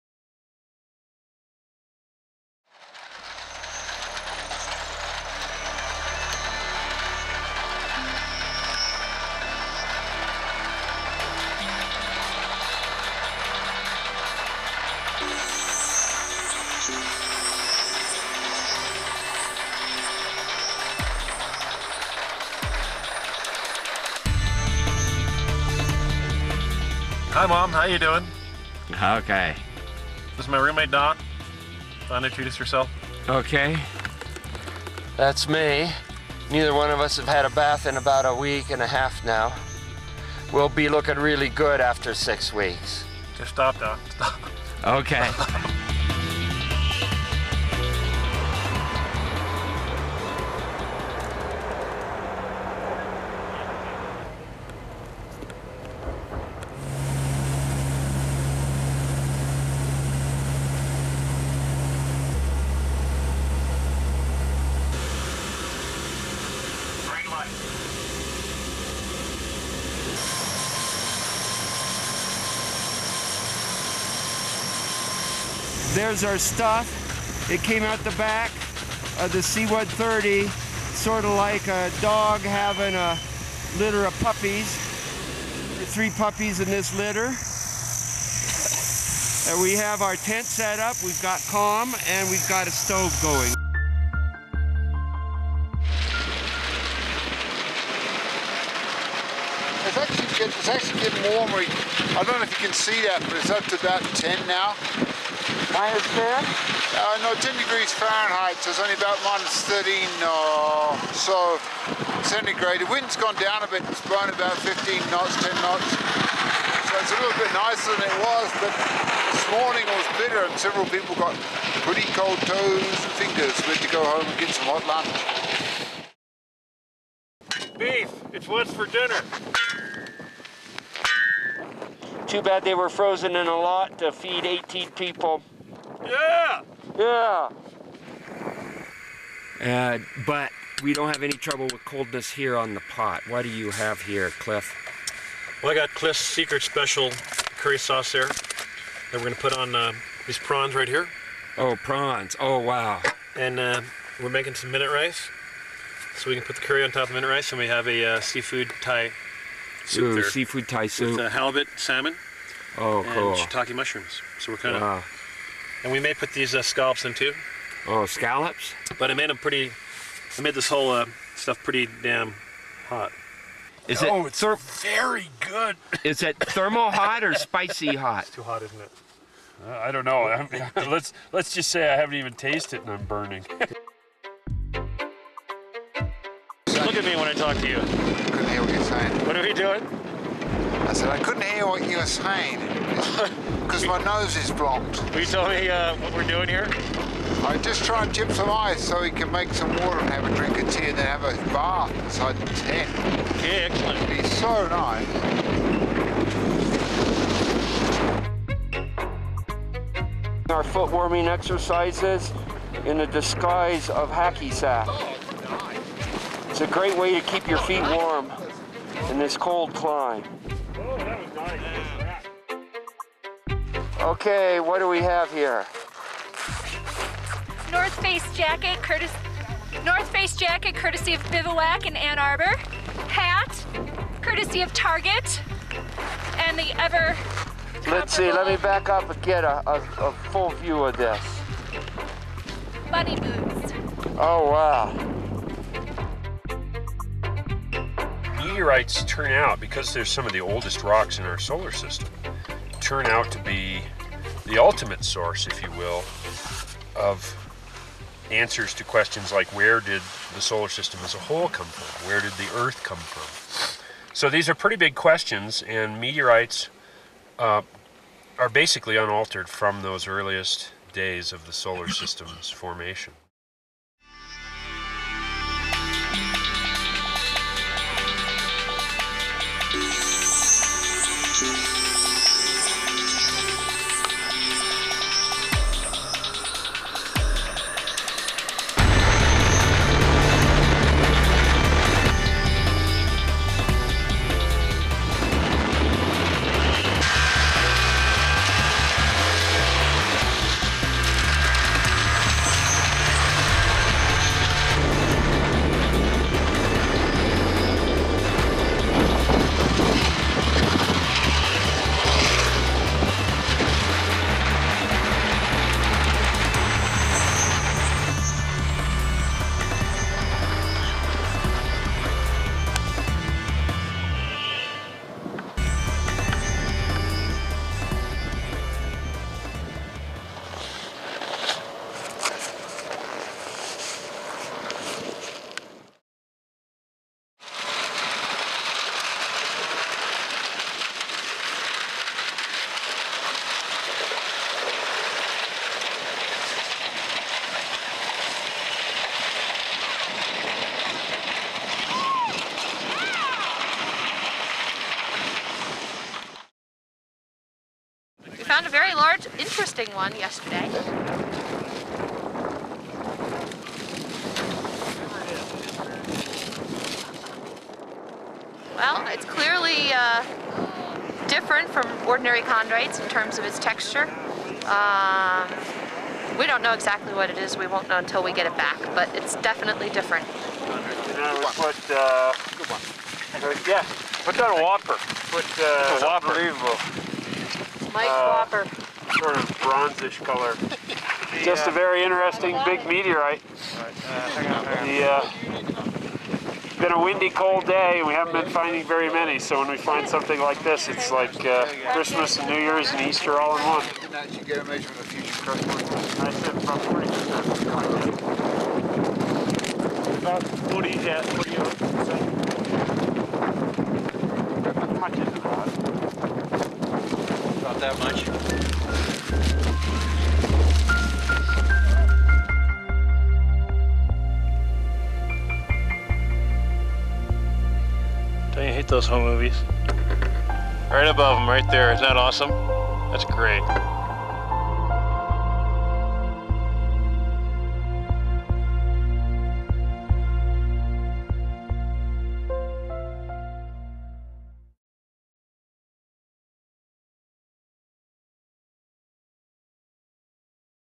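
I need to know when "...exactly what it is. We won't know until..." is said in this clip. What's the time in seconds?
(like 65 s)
376 s.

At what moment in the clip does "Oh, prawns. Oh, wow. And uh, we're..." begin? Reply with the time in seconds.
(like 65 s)
151 s.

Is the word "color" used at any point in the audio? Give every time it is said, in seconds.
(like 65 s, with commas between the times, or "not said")
390 s.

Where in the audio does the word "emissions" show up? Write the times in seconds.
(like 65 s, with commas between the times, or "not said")
not said.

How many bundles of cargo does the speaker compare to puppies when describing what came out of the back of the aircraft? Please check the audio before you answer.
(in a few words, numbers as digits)
3.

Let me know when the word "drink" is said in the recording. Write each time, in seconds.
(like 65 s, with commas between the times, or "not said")
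200 s.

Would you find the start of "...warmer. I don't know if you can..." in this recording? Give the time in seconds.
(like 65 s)
101 s.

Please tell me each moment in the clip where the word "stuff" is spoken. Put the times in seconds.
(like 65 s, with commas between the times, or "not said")
76 s, 171 s.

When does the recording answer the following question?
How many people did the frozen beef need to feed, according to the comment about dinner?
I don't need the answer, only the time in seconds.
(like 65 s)
134 s.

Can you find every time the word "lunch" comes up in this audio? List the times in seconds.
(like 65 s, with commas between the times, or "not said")
124 s.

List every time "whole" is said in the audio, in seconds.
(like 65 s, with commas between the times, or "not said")
170 s, 261 s.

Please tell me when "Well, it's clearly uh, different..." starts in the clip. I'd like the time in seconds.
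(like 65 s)
368 s.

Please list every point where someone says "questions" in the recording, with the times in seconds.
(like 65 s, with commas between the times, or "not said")
258 s, 264 s.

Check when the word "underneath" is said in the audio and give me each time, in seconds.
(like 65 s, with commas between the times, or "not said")
not said.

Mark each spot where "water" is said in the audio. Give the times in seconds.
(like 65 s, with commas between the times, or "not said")
199 s.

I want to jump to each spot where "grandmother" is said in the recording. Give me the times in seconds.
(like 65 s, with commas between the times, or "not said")
not said.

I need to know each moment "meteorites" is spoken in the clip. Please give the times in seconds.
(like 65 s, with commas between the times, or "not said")
248 s, 266 s, 392 s.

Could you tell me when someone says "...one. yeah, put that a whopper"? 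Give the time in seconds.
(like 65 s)
382 s.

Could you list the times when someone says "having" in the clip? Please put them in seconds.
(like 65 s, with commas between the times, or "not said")
82 s.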